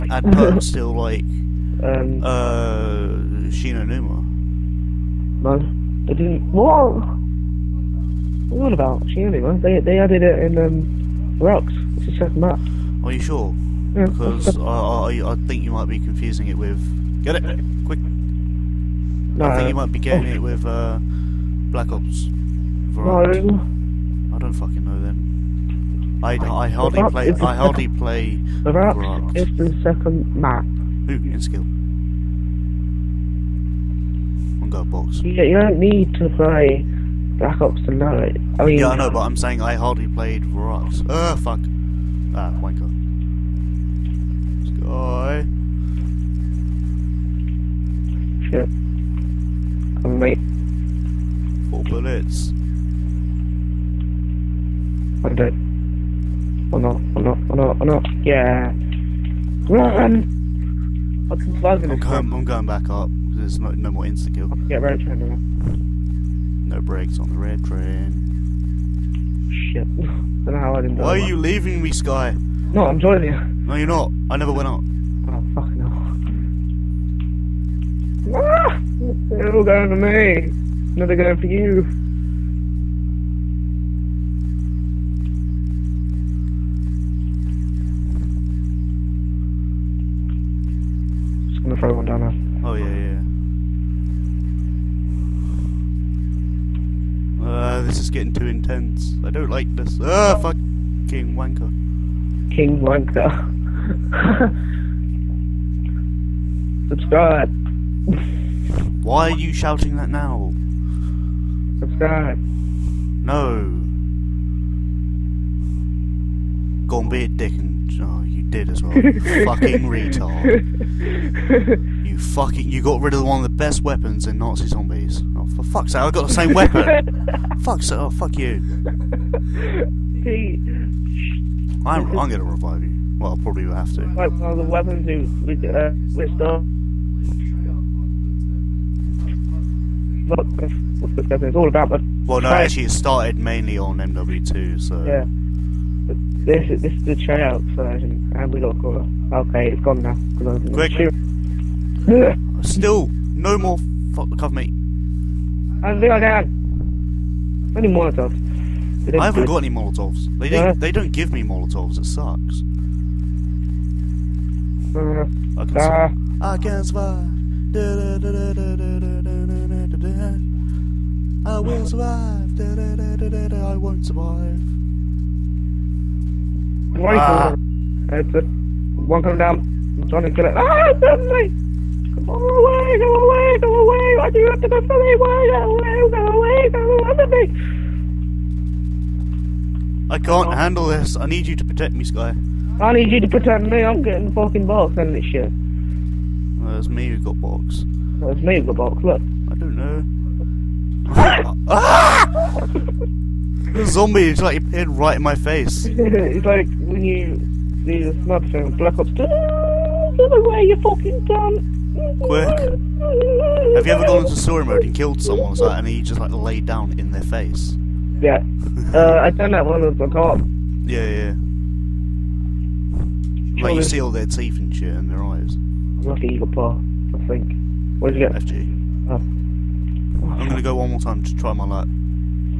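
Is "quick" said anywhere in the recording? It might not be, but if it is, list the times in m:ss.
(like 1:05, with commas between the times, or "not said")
0:17, 2:30, 3:32.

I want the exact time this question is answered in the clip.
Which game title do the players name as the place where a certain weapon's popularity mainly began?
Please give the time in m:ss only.
2:23.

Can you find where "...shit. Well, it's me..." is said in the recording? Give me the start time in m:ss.
3:15.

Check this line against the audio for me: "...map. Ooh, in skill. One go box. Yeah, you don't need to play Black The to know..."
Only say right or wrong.
wrong.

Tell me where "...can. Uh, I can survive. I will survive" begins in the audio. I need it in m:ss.
2:45.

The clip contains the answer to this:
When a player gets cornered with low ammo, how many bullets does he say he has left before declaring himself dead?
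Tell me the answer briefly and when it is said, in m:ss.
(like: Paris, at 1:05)
4, at 0:51.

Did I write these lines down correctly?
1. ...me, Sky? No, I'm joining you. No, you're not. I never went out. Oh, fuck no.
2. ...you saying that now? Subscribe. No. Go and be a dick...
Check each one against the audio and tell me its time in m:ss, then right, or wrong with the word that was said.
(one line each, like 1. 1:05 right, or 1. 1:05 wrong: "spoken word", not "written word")
1. 1:11 right
2. 1:49 wrong: "shouting", not "saying".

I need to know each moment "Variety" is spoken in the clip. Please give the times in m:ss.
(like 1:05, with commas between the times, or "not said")
0:22.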